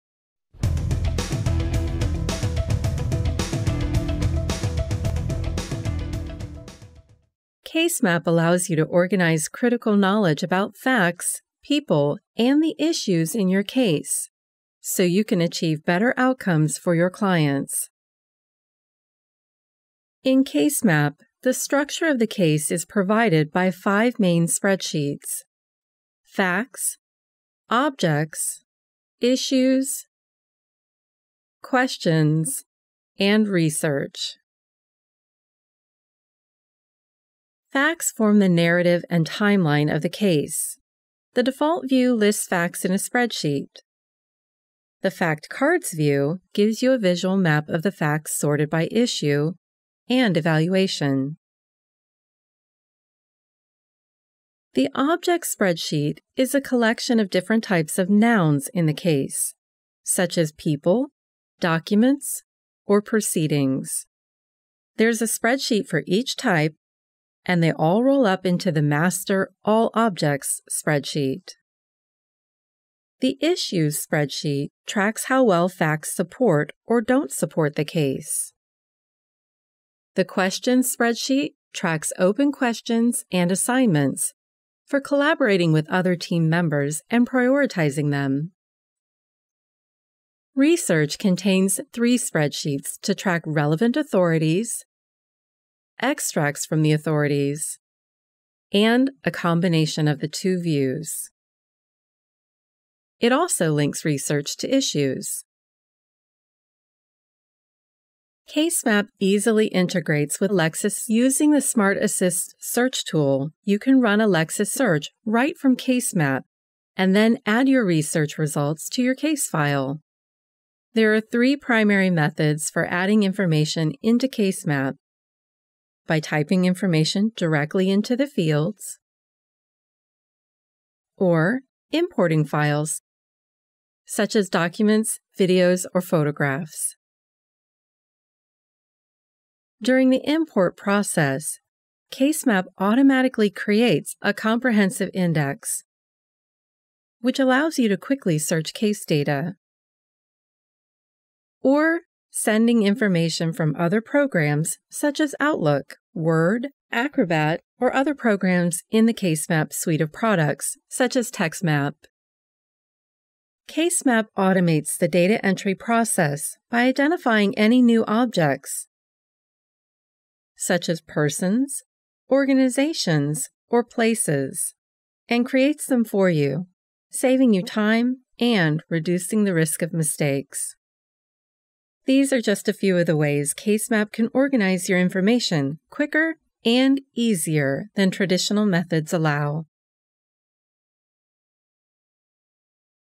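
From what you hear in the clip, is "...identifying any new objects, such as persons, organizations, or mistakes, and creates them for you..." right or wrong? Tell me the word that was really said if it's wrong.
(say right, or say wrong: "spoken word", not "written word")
wrong: "places", not "mistakes".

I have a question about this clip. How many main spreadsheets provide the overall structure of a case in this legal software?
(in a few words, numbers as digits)
5.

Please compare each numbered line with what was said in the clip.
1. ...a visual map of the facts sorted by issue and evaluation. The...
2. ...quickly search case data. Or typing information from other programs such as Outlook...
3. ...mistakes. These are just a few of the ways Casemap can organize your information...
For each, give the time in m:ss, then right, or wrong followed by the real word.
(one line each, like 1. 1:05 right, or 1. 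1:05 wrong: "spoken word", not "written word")
1. 0:46 right
2. 2:27 wrong: "sending", not "typing"
3. 2:59 right.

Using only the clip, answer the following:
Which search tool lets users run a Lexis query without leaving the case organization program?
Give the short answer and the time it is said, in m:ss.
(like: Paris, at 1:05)
Smart Assist, at 1:51.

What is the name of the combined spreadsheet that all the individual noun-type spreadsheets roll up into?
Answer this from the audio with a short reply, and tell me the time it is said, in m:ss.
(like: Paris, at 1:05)
Master All Objects, at 1:08.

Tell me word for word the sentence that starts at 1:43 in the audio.
It also links research to issues.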